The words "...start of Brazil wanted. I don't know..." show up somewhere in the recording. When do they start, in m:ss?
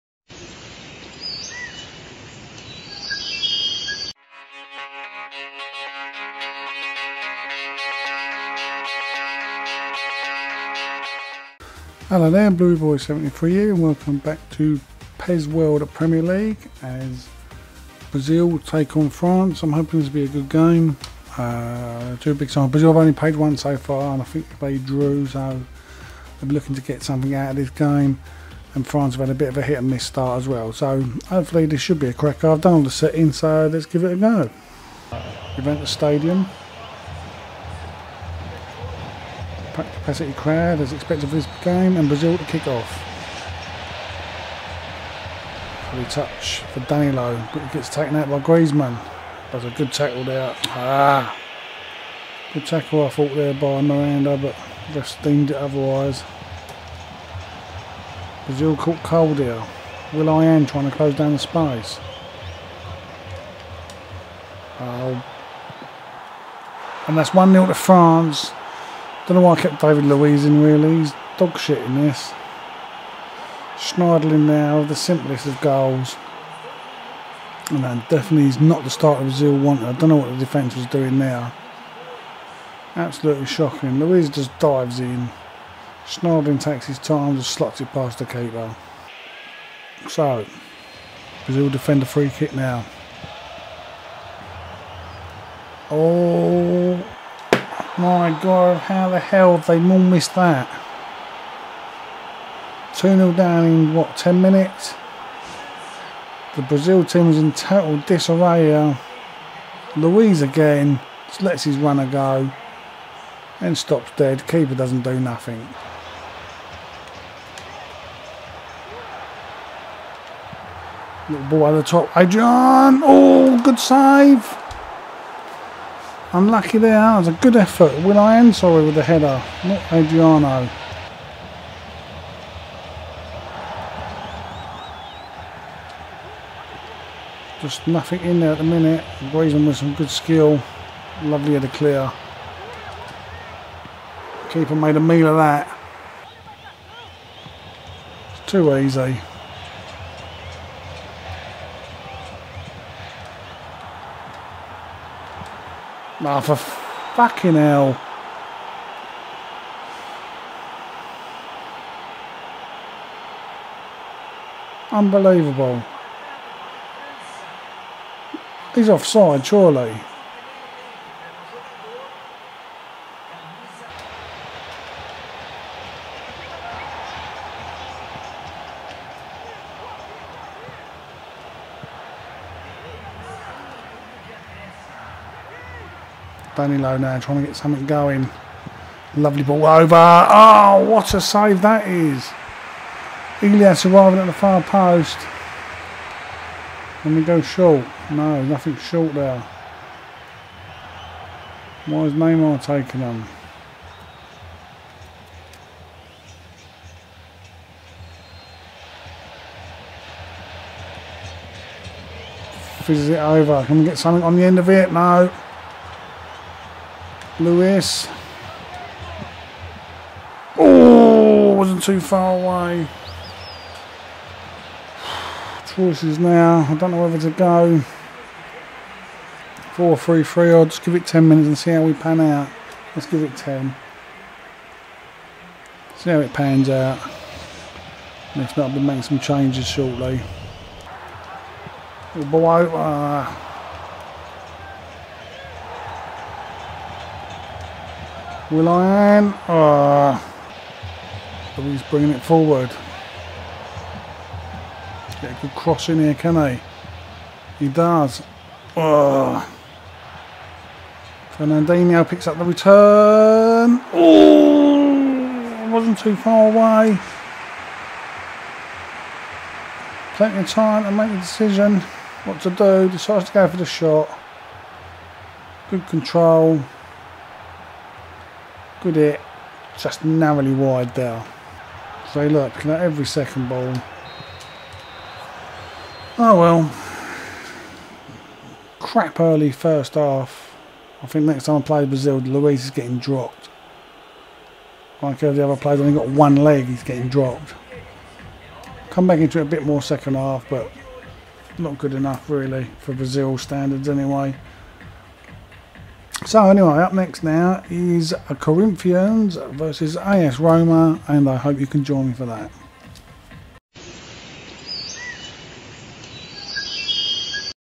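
1:18.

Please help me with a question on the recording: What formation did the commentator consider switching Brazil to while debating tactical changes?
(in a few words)
4-3-3.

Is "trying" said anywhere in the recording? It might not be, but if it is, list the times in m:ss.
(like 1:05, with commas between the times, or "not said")
1:00, 3:07.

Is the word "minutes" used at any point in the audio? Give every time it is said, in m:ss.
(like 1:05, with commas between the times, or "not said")
1:44, 2:18, 3:51.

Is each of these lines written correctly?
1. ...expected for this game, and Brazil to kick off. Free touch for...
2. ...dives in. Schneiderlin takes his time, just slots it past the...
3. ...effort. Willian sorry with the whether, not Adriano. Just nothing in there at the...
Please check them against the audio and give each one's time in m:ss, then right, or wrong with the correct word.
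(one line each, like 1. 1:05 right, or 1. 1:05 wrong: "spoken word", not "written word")
1. 0:40 right
2. 1:24 right
3. 2:07 wrong: "header", not "whether".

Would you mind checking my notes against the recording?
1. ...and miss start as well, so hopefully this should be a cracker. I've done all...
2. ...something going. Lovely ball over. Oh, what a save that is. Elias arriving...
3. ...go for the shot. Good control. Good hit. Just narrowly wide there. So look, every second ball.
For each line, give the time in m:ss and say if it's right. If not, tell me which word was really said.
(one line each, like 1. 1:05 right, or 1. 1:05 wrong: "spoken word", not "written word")
1. 0:29 right
2. 3:07 right
3. 4:33 right.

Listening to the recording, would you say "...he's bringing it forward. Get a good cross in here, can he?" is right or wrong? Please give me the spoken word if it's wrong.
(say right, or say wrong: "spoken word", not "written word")
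right.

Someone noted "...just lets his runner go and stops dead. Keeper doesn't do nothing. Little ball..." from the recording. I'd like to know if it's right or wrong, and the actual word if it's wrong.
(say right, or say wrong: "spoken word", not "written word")
right.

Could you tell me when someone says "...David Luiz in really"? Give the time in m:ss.
1:09.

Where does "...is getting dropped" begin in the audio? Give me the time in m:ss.
4:52.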